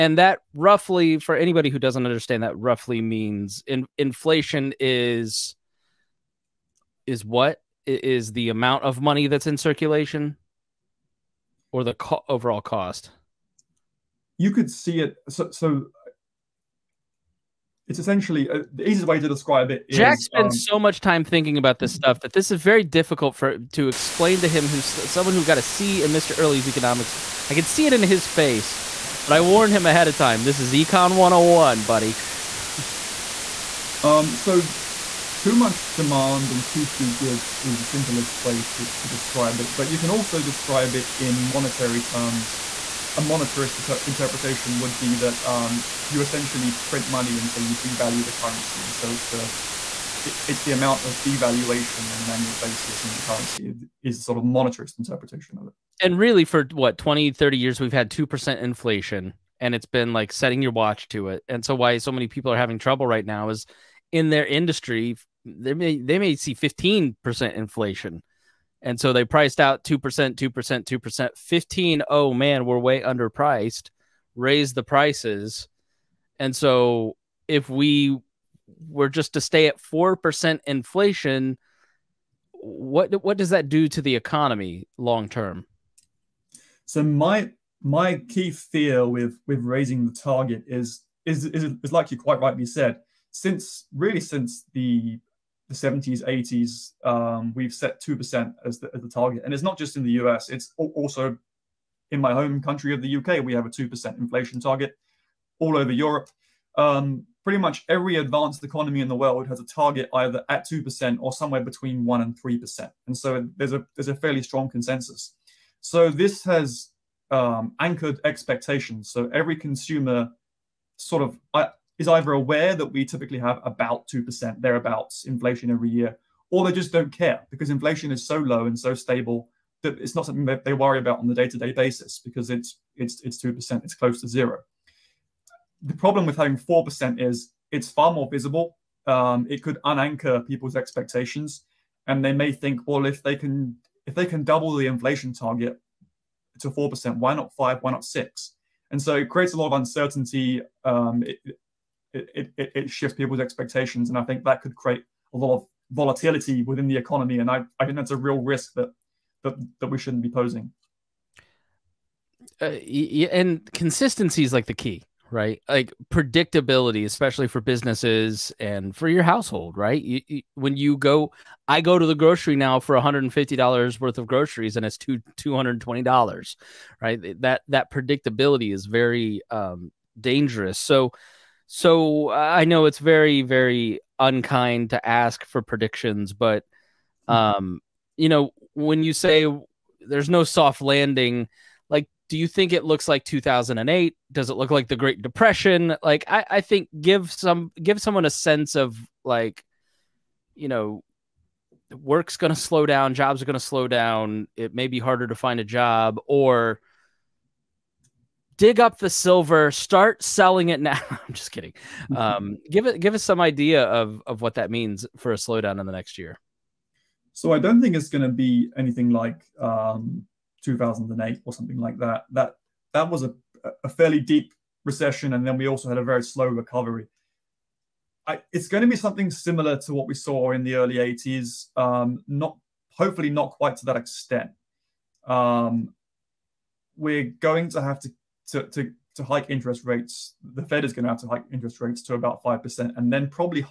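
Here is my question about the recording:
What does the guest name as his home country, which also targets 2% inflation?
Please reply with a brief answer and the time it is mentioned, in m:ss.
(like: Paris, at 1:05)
UK, at 1:43.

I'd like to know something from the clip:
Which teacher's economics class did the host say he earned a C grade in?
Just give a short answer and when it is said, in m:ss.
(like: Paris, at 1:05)
Mr. Early, at 0:26.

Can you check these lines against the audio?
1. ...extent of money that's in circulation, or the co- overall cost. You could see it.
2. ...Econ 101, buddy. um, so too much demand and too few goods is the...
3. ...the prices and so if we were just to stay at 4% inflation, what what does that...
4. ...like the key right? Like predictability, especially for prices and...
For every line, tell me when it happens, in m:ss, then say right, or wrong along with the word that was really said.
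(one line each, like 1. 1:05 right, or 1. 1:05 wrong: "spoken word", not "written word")
1. 0:08 wrong: "amount", not "extent"
2. 0:30 right
3. 1:14 right
4. 2:44 wrong: "businesses", not "prices".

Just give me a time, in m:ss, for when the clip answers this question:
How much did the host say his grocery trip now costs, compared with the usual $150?
2:55.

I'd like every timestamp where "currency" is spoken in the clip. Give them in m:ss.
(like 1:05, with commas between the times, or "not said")
0:48, 0:53.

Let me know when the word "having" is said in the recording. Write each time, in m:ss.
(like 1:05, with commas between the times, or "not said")
1:02, 2:16.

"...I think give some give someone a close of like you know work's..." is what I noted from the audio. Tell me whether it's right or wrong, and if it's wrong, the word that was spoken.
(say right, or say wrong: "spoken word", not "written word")
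wrong: "sense", not "close".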